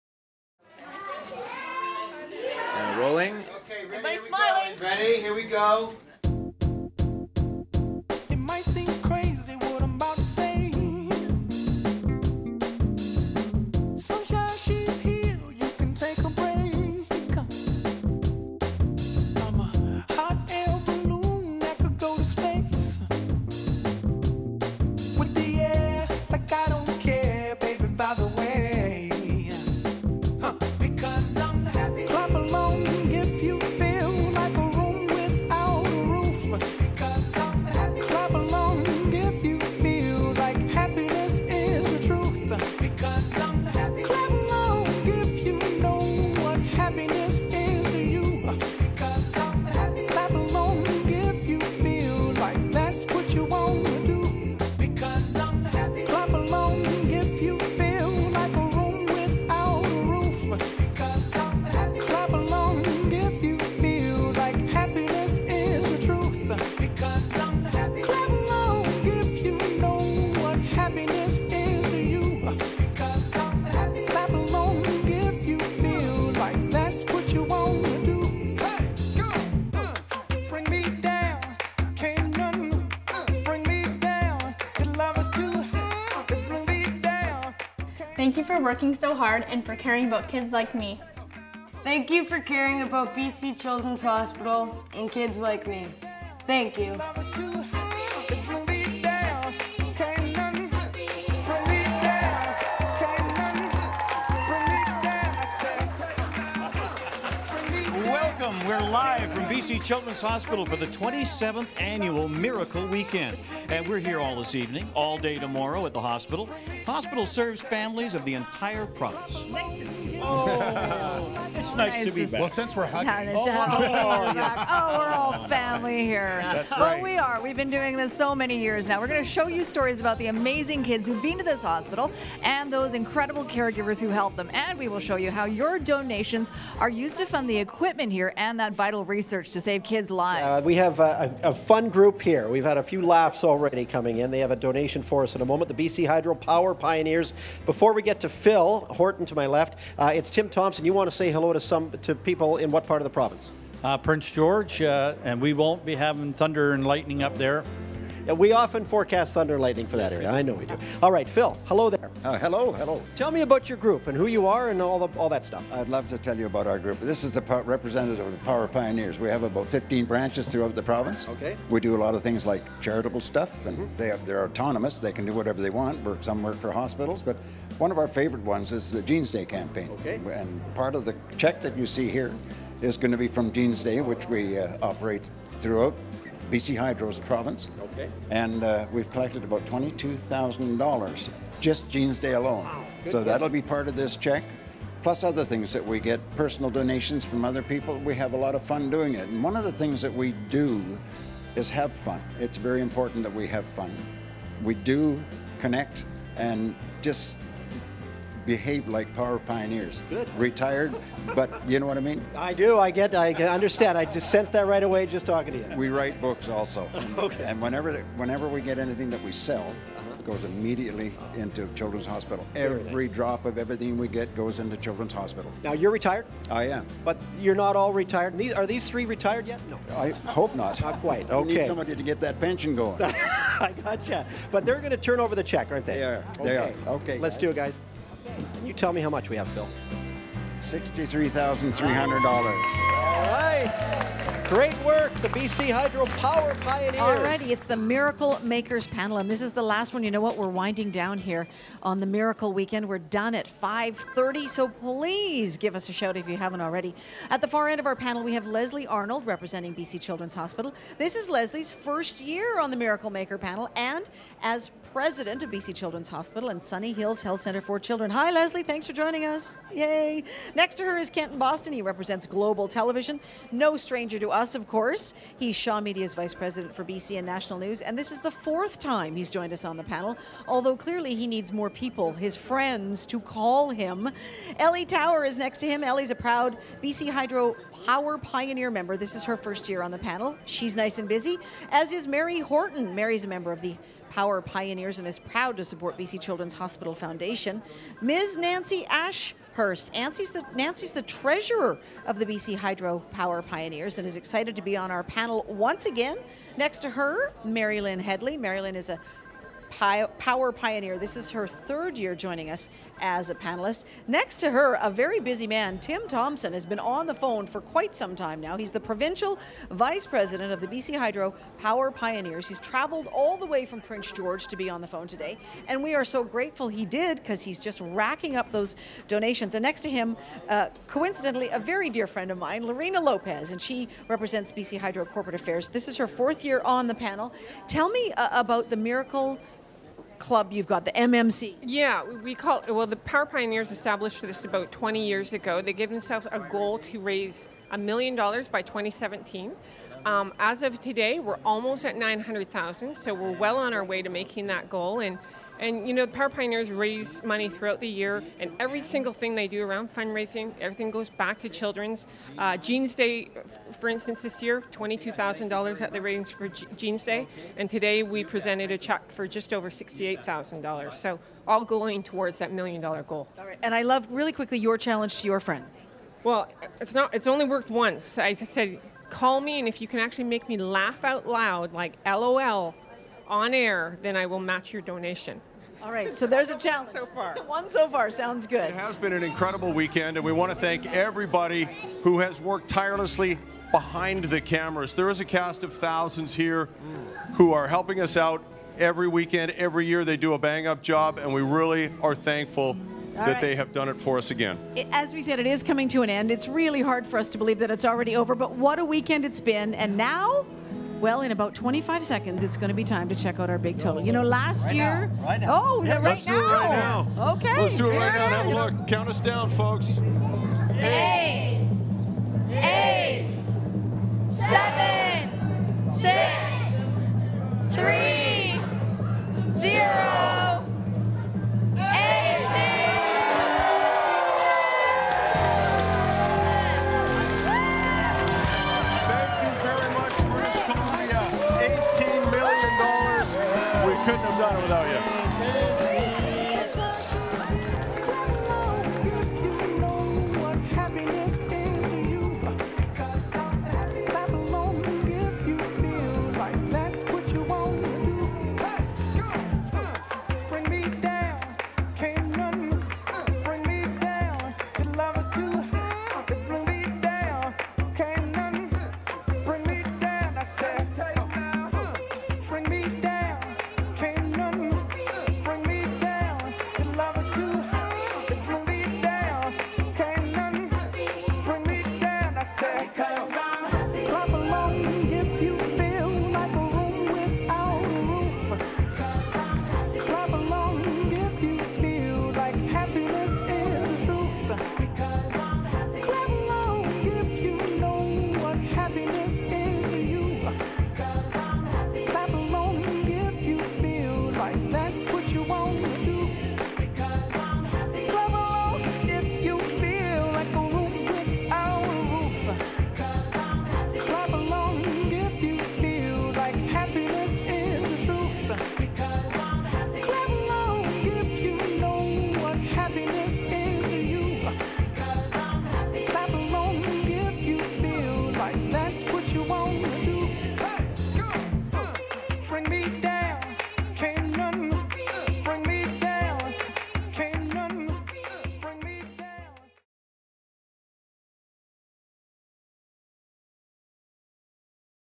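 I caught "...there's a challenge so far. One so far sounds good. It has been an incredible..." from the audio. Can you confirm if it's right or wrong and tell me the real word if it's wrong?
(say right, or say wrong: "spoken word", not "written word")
right.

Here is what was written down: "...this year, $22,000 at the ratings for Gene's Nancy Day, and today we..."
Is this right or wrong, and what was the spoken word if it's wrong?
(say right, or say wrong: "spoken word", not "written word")
wrong: "Jeans", not "Nancy".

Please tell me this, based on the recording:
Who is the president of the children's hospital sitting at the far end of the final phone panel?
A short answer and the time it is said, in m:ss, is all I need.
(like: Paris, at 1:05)
Leslie Arnold, at 4:18.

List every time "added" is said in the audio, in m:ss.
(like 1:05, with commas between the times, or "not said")
not said.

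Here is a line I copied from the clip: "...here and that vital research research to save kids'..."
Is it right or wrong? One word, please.
right.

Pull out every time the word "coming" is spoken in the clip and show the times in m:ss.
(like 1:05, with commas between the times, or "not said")
2:23, 6:45.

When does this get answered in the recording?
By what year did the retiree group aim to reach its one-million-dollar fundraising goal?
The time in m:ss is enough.
5:48.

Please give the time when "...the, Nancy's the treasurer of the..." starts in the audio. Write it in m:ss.
5:00.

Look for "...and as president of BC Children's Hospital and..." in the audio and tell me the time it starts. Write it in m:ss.
4:23.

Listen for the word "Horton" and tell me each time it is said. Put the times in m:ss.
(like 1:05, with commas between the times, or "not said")
2:28, 4:52.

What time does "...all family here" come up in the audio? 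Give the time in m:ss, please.
2:05.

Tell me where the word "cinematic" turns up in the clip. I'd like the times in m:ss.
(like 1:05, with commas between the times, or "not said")
not said.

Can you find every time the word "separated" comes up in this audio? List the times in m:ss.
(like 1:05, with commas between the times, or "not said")
not said.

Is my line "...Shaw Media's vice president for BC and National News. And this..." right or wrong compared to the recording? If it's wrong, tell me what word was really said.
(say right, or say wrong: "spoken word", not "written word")
right.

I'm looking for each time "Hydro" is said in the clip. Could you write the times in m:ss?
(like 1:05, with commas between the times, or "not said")
2:26, 3:06, 4:05, 4:47, 5:02, 5:20, 5:34.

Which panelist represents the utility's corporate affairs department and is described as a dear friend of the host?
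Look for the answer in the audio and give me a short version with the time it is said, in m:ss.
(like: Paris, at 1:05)
Lorena Lopez, at 5:32.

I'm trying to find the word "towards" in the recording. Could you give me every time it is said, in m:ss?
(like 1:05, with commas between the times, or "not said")
6:12.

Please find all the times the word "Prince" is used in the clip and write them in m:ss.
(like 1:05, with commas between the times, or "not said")
2:33, 5:23.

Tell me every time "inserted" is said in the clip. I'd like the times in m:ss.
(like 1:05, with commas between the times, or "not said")
not said.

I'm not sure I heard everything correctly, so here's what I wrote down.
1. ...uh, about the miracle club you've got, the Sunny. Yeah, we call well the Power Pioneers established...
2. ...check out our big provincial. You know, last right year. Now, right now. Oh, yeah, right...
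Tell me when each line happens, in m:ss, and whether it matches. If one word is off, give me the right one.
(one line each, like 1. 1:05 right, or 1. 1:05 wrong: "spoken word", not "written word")
1. 5:38 wrong: "MMC", not "Sunny"
2. 6:53 wrong: "total", not "provincial".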